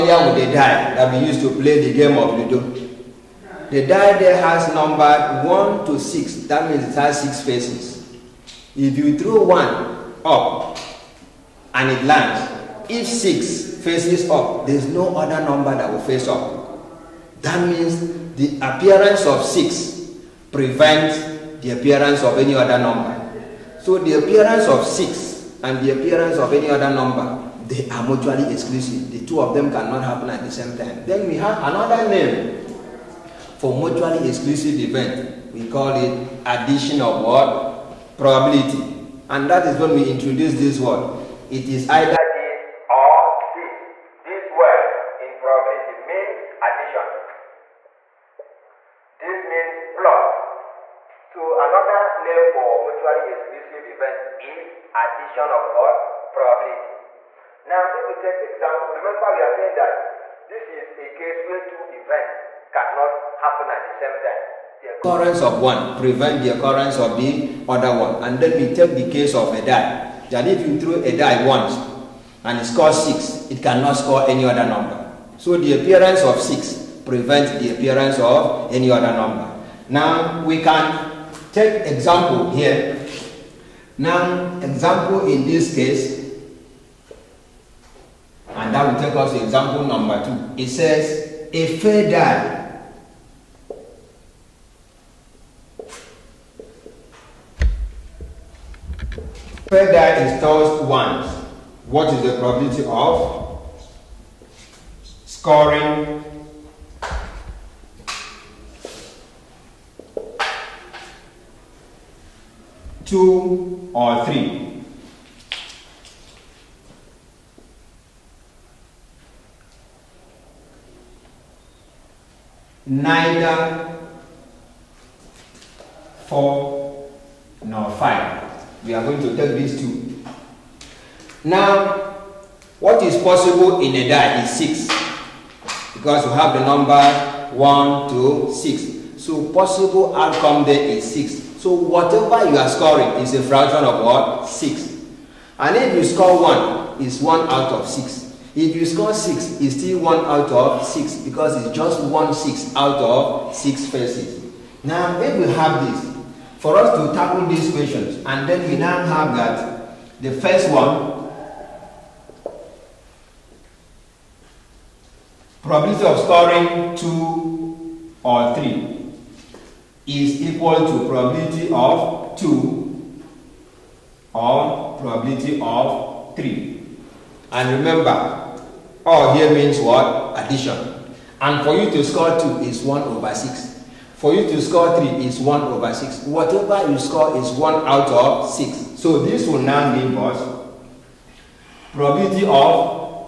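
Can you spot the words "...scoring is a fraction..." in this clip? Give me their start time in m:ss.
2:22.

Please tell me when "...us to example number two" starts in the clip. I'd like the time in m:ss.
1:29.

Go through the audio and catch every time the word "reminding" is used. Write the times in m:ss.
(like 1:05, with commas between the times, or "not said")
not said.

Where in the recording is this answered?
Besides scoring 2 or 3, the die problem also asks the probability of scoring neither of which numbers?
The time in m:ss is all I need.
2:06.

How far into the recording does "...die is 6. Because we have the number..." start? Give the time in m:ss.
2:14.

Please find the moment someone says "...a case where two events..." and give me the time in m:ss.
1:00.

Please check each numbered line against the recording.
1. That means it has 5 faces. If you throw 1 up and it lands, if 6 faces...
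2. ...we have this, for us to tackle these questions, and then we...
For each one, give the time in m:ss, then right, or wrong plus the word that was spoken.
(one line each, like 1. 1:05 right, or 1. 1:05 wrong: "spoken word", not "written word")
1. 0:06 wrong: "6", not "5"
2. 2:35 right.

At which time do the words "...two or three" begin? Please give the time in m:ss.
2:46.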